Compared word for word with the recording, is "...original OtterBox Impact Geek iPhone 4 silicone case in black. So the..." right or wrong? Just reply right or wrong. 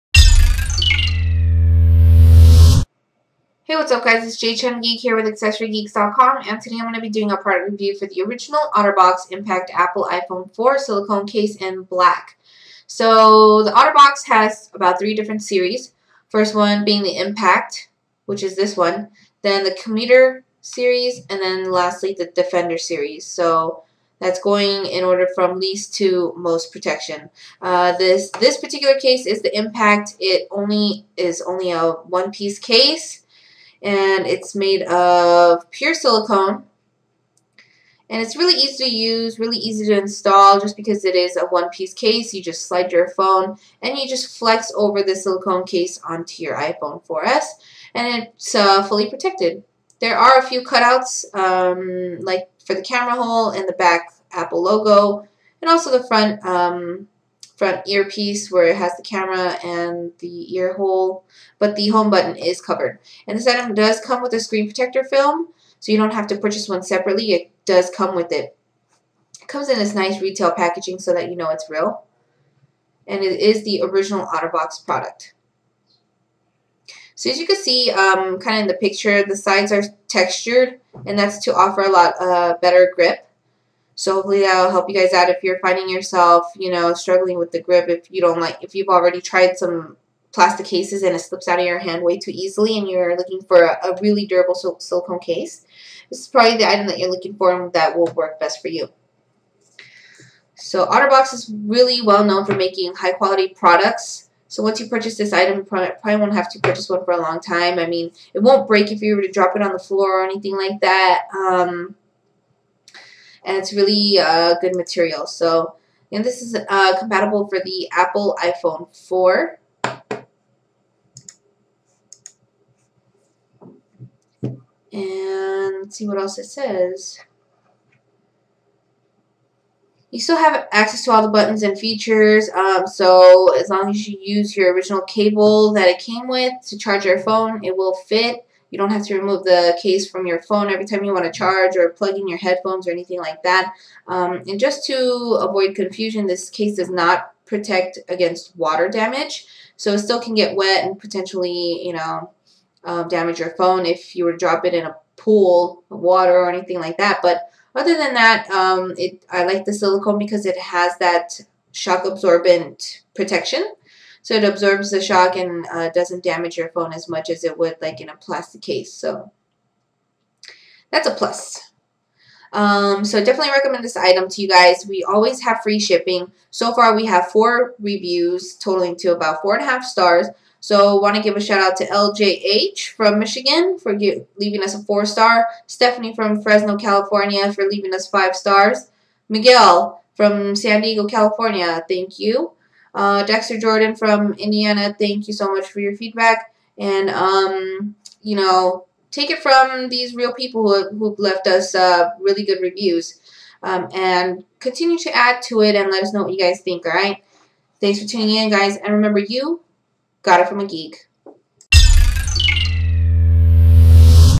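wrong.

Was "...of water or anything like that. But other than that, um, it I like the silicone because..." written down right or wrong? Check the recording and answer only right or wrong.
right.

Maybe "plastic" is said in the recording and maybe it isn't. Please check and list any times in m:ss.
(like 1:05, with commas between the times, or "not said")
1:30, 2:48.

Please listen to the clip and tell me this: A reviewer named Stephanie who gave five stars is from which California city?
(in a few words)
Fresno.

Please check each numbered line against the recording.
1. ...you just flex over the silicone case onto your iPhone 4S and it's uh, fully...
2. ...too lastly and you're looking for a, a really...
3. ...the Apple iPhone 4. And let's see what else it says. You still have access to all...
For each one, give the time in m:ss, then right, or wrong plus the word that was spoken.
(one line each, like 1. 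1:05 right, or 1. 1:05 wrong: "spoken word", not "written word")
1. 0:43 right
2. 1:32 wrong: "easily", not "lastly"
3. 1:57 right.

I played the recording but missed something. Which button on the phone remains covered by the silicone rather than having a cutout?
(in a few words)
home button.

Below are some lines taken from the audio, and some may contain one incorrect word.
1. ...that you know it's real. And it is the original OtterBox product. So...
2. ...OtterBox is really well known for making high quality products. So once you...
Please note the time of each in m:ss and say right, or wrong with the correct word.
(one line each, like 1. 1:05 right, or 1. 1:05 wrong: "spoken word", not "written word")
1. 1:11 right
2. 1:40 right.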